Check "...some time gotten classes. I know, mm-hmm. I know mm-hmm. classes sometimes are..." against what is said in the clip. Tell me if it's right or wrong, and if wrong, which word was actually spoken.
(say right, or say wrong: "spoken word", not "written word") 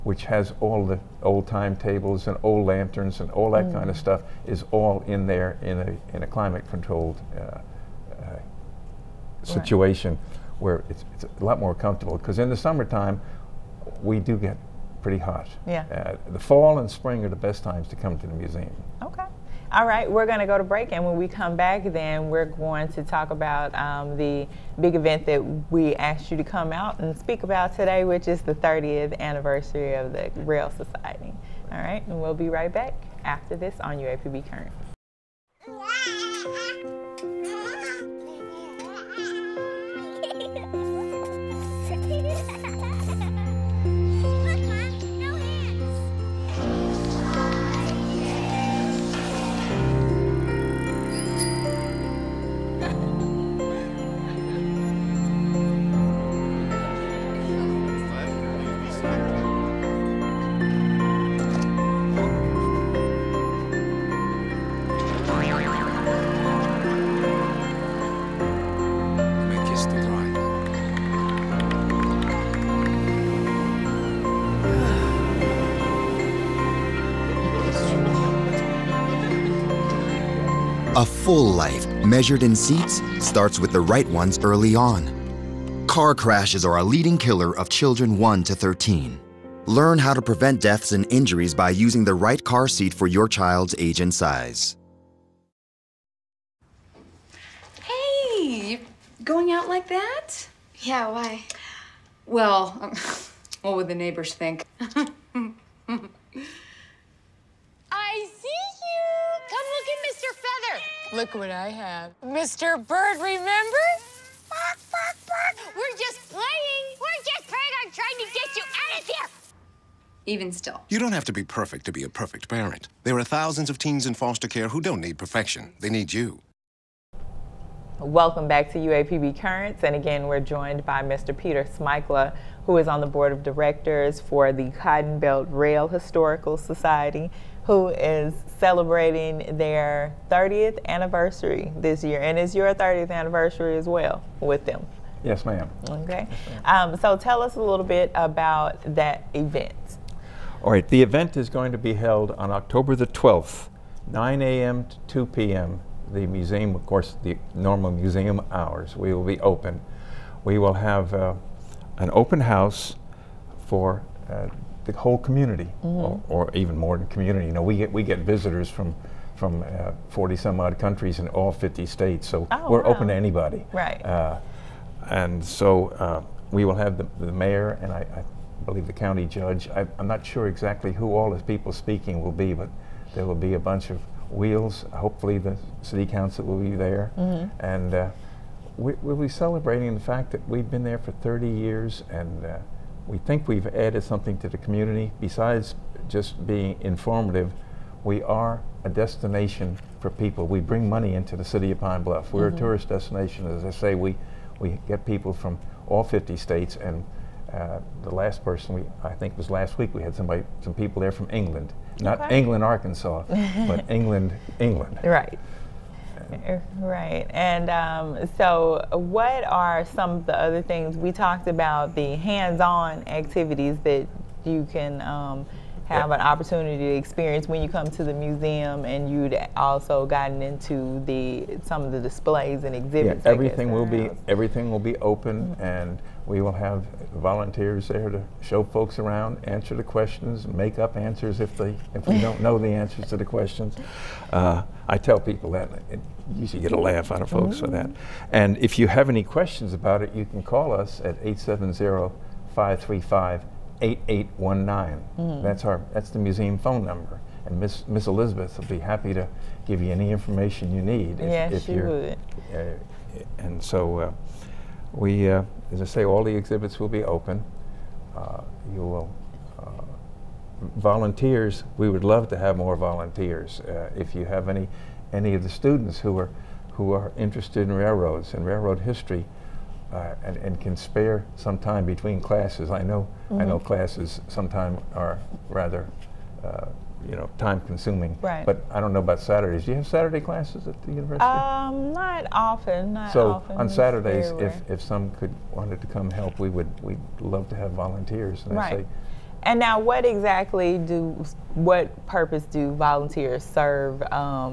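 wrong: "between", not "gotten".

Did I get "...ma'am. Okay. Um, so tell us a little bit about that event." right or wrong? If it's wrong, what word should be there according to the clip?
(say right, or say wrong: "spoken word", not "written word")
right.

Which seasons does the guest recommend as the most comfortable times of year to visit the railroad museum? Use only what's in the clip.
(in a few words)
fall and spring.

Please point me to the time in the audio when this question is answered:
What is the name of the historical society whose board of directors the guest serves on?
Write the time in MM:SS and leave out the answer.
02:14.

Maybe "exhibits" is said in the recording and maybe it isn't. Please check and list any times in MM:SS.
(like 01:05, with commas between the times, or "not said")
03:52, 04:26.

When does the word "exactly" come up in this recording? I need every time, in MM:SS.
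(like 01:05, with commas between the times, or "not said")
03:00, 05:00.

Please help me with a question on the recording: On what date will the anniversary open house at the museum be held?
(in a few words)
October 12.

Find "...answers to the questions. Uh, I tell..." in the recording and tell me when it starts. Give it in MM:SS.
04:02.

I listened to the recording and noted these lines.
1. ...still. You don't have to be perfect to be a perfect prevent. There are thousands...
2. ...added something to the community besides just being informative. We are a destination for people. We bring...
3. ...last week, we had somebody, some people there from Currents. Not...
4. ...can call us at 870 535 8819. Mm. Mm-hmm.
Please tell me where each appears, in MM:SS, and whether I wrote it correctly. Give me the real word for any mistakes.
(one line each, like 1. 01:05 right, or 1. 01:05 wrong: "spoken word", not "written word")
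1. 02:00 wrong: "parent", not "prevent"
2. 03:13 right
3. 03:29 wrong: "England", not "Currents"
4. 04:10 right.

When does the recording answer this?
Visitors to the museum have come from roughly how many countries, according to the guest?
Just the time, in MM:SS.
02:50.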